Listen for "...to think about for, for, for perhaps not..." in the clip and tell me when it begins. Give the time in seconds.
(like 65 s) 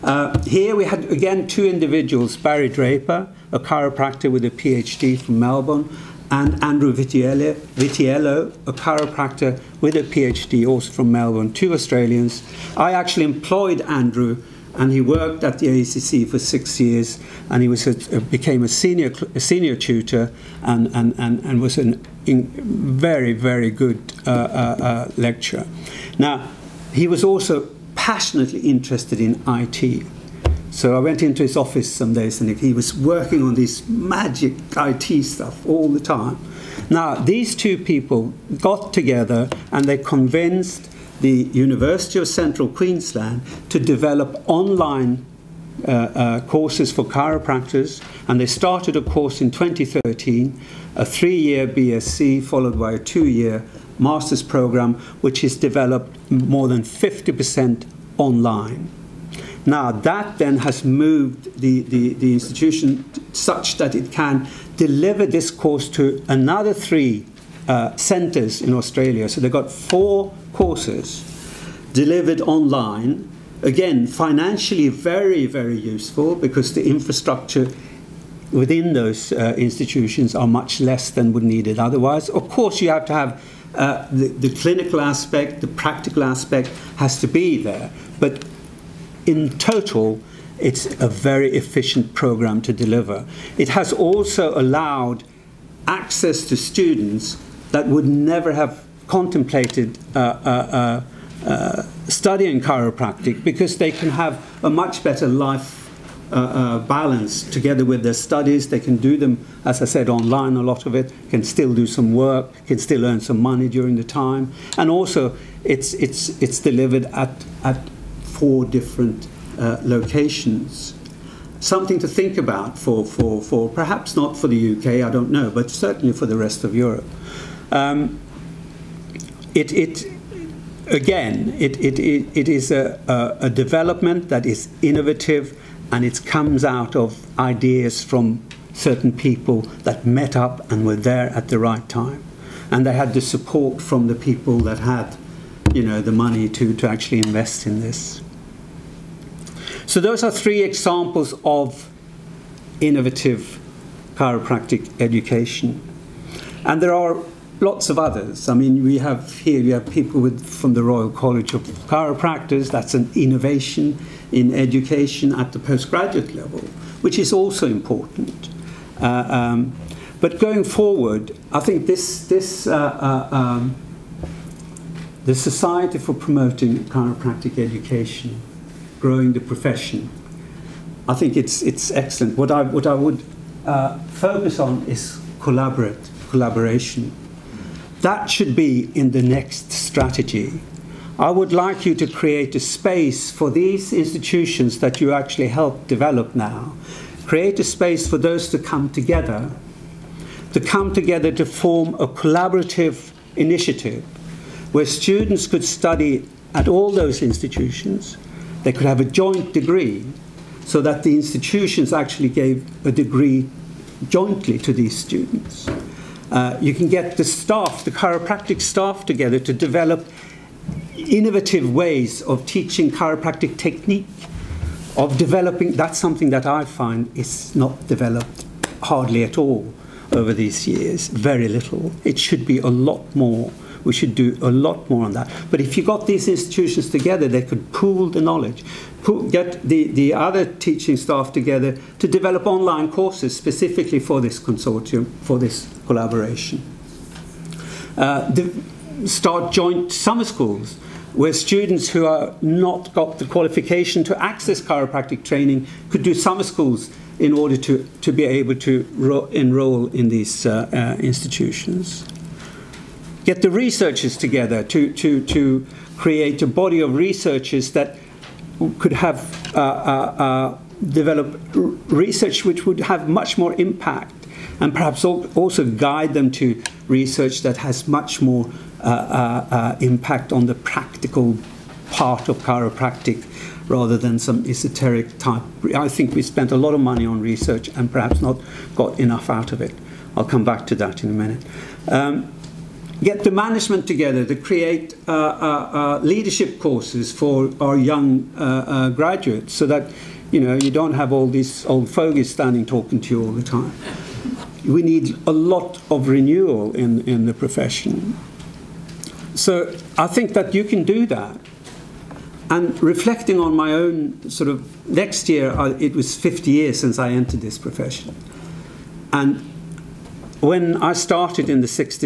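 121 s.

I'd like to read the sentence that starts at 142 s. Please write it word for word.
And they had the support from the people that had, you know, the money to, to actually invest in this.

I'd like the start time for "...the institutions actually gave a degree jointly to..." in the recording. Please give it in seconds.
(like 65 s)
211 s.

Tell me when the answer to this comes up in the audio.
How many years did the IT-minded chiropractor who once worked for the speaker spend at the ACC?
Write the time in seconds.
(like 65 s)
16 s.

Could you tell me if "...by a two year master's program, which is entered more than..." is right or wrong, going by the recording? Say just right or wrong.
wrong.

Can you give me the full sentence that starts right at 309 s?
So I think that you can do that.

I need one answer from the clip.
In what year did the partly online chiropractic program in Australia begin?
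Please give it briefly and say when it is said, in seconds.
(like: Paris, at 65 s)
2013, at 49 s.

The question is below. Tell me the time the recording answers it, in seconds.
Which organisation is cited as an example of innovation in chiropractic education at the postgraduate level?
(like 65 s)
160 s.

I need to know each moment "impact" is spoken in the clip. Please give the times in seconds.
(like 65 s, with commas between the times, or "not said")
273 s, 279 s.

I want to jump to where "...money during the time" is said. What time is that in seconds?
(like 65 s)
113 s.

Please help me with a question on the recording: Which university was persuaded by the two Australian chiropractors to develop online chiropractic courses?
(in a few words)
University of Central Queensland.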